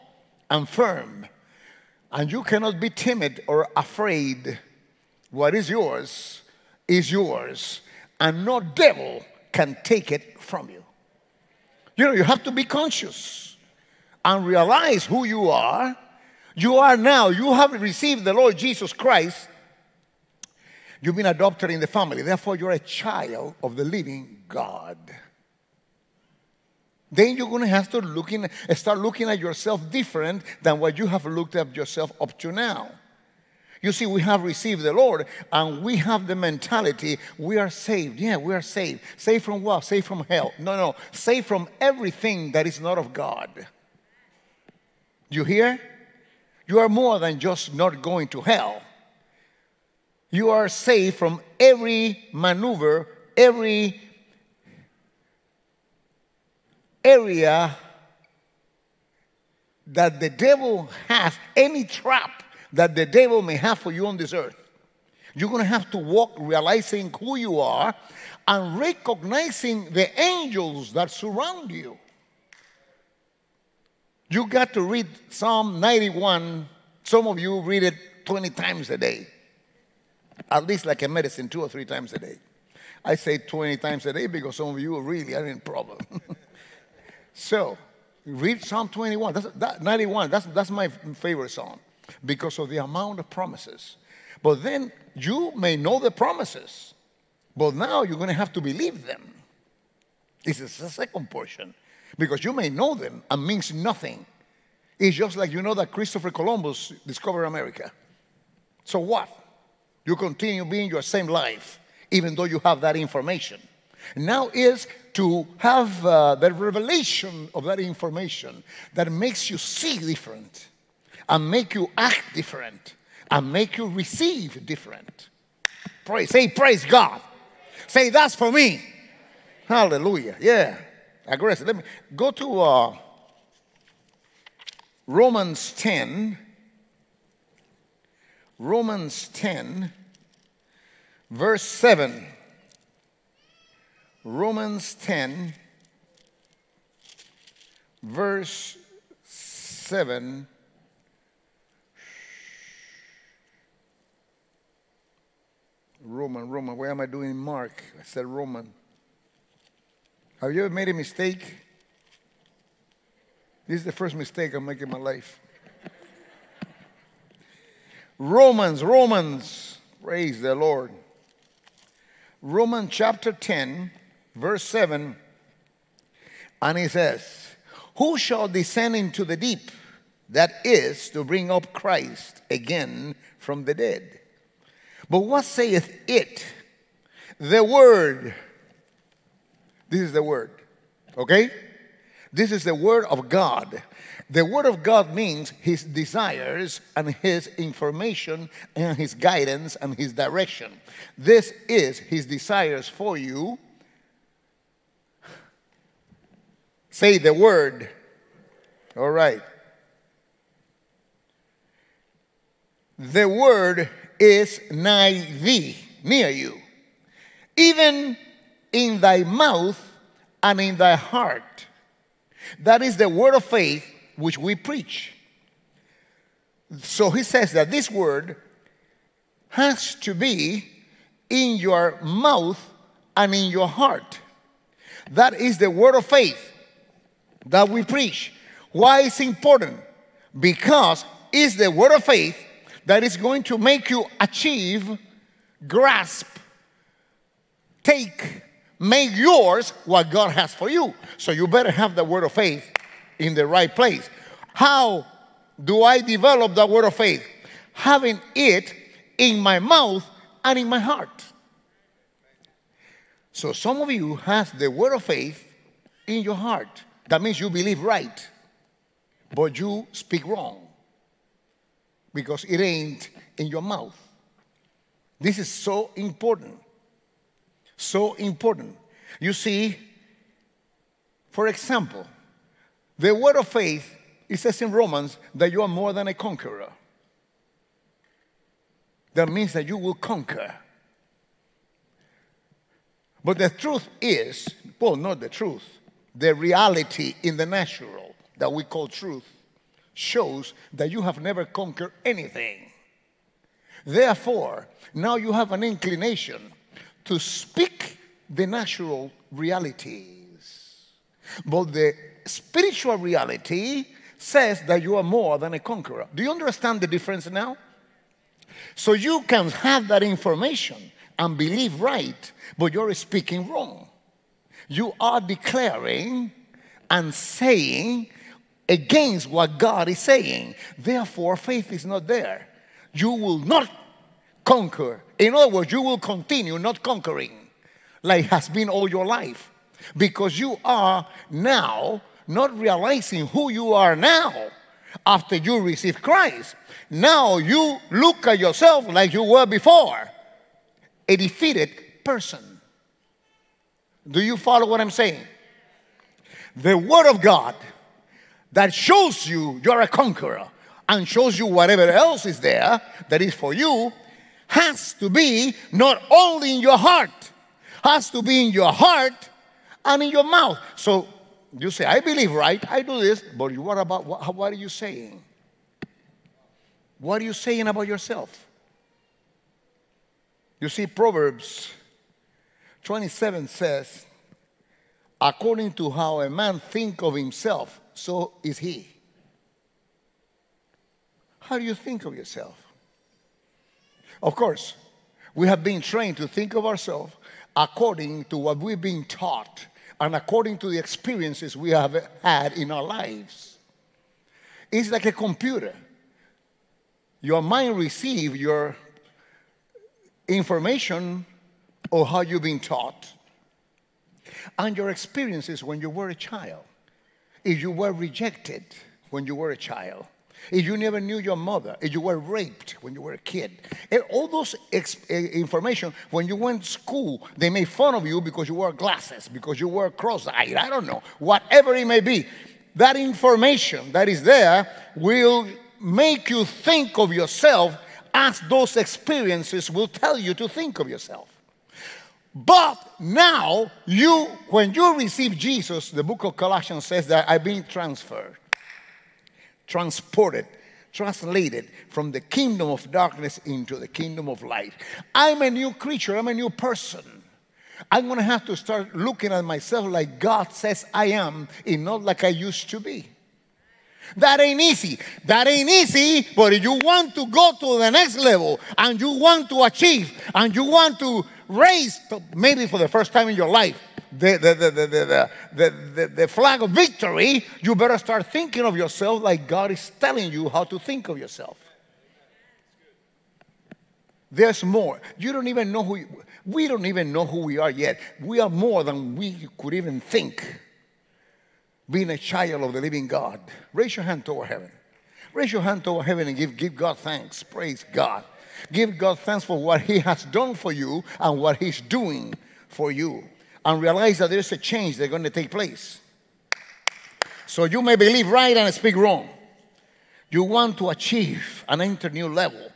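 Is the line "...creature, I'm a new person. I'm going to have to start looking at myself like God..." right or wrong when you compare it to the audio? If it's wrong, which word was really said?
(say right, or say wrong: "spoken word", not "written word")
right.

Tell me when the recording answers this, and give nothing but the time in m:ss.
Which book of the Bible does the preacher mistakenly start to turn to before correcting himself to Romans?
2:37.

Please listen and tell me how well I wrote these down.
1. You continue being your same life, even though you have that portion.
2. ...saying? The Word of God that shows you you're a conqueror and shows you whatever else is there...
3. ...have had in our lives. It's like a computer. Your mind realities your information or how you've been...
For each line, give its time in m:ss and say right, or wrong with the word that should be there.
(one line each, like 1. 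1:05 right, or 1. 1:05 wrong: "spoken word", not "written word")
1. 1:50 wrong: "information", not "portion"
2. 5:54 right
3. 6:41 wrong: "receives", not "realities".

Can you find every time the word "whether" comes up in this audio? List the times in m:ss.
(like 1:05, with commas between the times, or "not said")
not said.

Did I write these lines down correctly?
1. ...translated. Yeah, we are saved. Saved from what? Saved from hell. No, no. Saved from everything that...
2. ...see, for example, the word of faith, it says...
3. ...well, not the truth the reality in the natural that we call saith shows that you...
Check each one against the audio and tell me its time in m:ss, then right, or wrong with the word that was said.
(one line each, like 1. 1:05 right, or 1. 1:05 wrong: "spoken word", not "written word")
1. 0:37 wrong: "saved", not "translated"
2. 4:39 right
3. 4:54 wrong: "truth", not "saith".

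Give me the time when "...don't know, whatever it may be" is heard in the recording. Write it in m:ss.
7:10.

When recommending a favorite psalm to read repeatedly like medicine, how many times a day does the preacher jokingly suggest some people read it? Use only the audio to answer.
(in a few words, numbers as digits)
20.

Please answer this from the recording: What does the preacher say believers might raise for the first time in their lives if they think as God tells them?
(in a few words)
flag of victory.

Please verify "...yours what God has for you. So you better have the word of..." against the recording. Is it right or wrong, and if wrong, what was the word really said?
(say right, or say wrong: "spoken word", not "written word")
right.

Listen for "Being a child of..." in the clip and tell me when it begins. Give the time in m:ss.
8:11.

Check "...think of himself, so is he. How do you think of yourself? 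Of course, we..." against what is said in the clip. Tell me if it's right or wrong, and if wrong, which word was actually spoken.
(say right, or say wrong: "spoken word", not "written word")
right.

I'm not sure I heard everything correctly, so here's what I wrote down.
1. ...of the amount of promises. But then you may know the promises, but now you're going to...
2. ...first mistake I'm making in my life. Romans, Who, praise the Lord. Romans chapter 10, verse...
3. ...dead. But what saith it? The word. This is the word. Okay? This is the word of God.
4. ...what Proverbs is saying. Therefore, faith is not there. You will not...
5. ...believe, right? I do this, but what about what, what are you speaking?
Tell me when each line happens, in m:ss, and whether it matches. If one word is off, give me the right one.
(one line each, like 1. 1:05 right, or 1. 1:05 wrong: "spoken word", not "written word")
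1. 1:32 right
2. 2:43 wrong: "Romans", not "Who"
3. 3:03 right
4. 5:29 wrong: "God", not "Proverbs"
5. 6:11 wrong: "saying", not "speaking".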